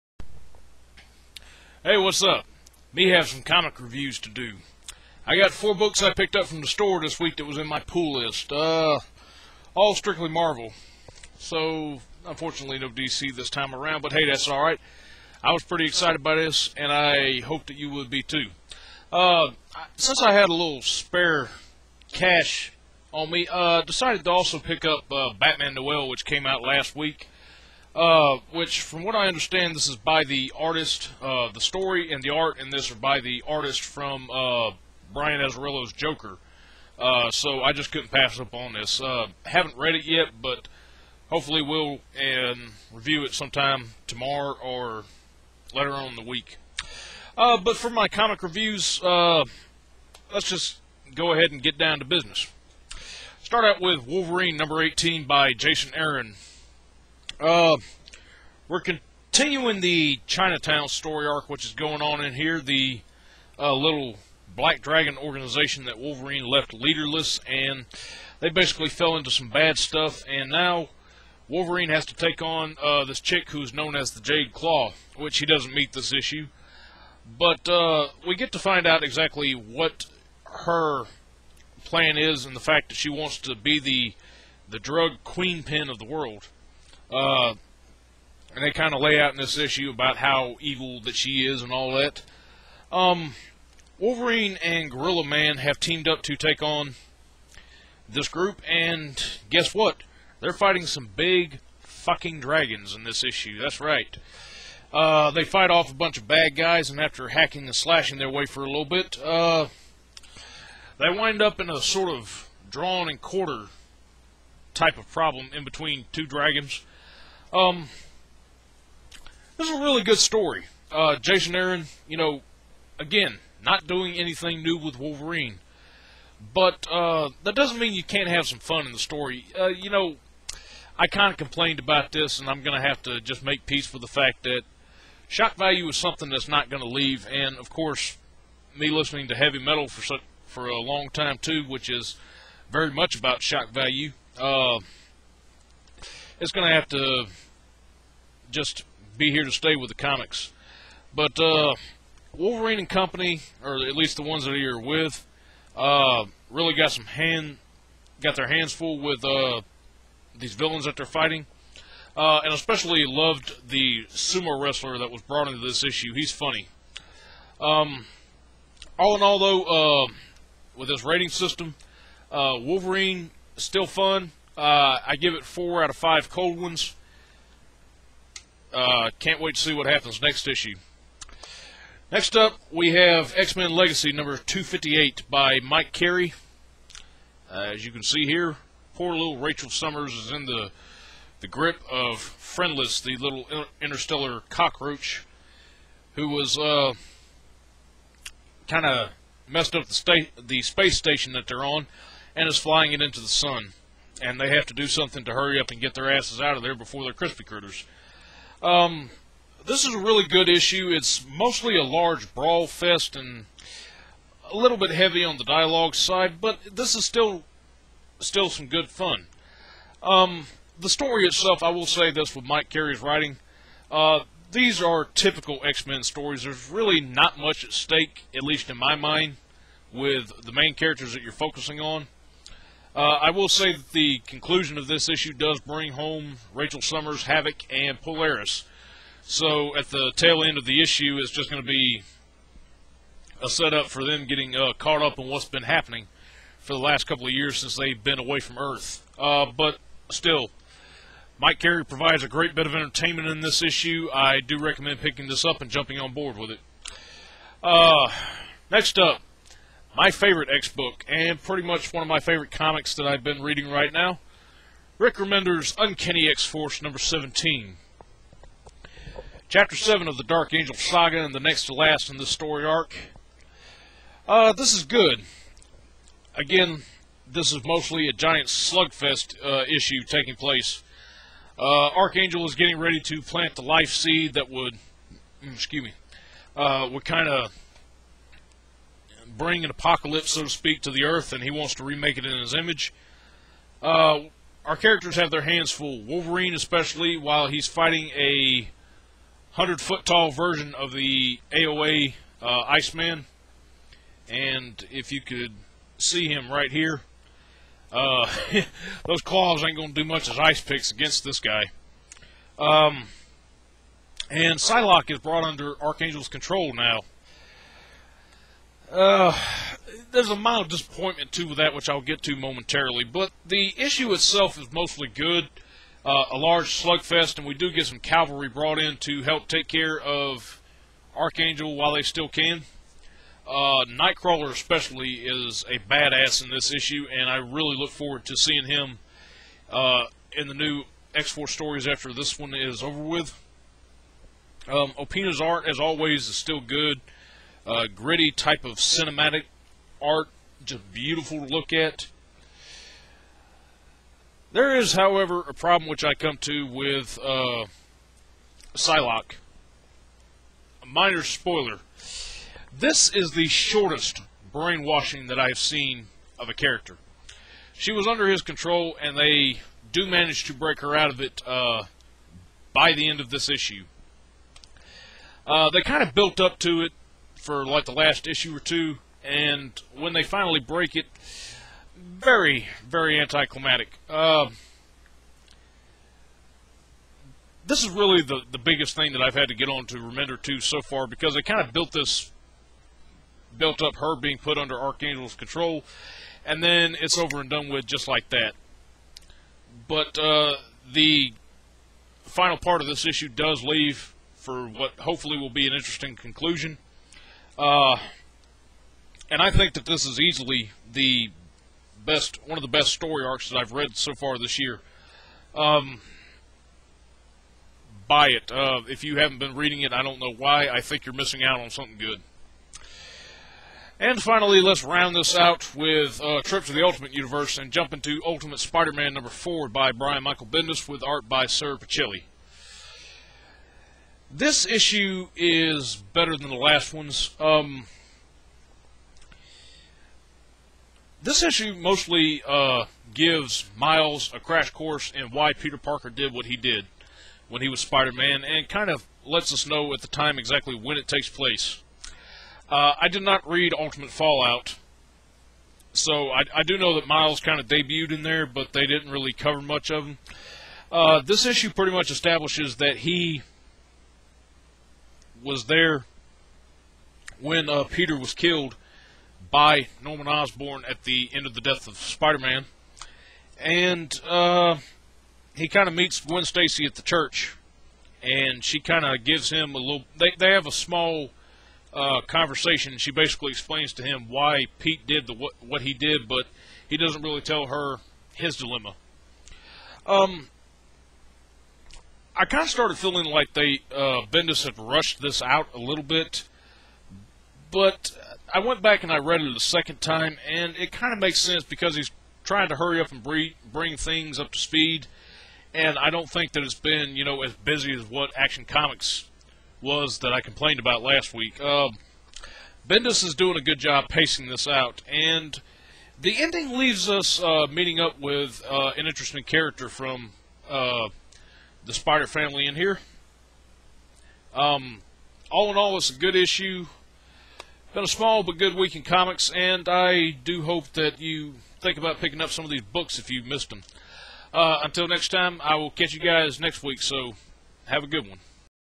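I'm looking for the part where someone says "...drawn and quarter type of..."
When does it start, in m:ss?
1:52.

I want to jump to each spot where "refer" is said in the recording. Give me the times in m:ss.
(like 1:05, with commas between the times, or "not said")
not said.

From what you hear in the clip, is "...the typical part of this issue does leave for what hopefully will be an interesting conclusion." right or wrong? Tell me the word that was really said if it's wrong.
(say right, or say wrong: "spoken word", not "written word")
wrong: "final", not "typical".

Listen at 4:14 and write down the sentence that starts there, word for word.
I do recommend picking this up and jumping on board with it.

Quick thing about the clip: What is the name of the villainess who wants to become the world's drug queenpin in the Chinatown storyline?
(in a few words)
Jade Claw.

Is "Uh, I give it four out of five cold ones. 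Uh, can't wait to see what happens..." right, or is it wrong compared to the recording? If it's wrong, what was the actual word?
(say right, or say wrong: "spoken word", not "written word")
right.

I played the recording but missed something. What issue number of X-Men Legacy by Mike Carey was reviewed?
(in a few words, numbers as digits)
258.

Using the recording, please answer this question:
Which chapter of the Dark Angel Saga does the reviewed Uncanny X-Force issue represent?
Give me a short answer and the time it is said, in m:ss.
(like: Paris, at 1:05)
Chapter 7, at 4:29.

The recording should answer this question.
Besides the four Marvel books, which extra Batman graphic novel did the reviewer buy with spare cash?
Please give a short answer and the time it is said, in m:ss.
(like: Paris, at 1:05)
Batman Noel, at 0:25.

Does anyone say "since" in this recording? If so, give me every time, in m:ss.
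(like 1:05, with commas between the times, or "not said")
0:19, 4:07.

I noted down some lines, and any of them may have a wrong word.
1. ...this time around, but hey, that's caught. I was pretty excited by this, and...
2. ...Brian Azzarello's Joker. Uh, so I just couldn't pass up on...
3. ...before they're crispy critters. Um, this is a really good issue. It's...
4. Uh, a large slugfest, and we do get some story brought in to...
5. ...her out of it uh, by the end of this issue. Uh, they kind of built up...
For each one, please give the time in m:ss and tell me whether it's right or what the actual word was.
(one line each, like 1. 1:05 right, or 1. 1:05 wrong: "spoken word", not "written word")
1. 0:13 wrong: "alright", not "caught"
2. 0:35 right
3. 3:26 right
4. 5:26 wrong: "cavalry", not "story"
5. 6:10 right.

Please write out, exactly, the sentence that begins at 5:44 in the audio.
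Um, Opeña's art, as always, is still good uh, gritty type of cinematic art, just beautiful to look at.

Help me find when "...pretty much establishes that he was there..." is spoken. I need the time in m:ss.
7:41.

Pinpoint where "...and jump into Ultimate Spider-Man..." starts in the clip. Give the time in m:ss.
7:07.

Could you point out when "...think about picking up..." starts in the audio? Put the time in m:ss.
8:51.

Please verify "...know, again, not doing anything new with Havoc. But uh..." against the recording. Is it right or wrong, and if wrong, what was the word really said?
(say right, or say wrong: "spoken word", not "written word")
wrong: "Wolverine", not "Havoc".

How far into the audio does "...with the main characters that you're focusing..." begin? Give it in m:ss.
3:49.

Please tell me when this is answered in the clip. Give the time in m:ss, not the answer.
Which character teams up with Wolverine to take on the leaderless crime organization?
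1:34.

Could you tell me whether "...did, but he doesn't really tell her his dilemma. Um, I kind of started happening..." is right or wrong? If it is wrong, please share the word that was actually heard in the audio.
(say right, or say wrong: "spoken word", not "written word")
wrong: "feeling", not "happening".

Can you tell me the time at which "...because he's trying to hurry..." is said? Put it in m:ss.
8:21.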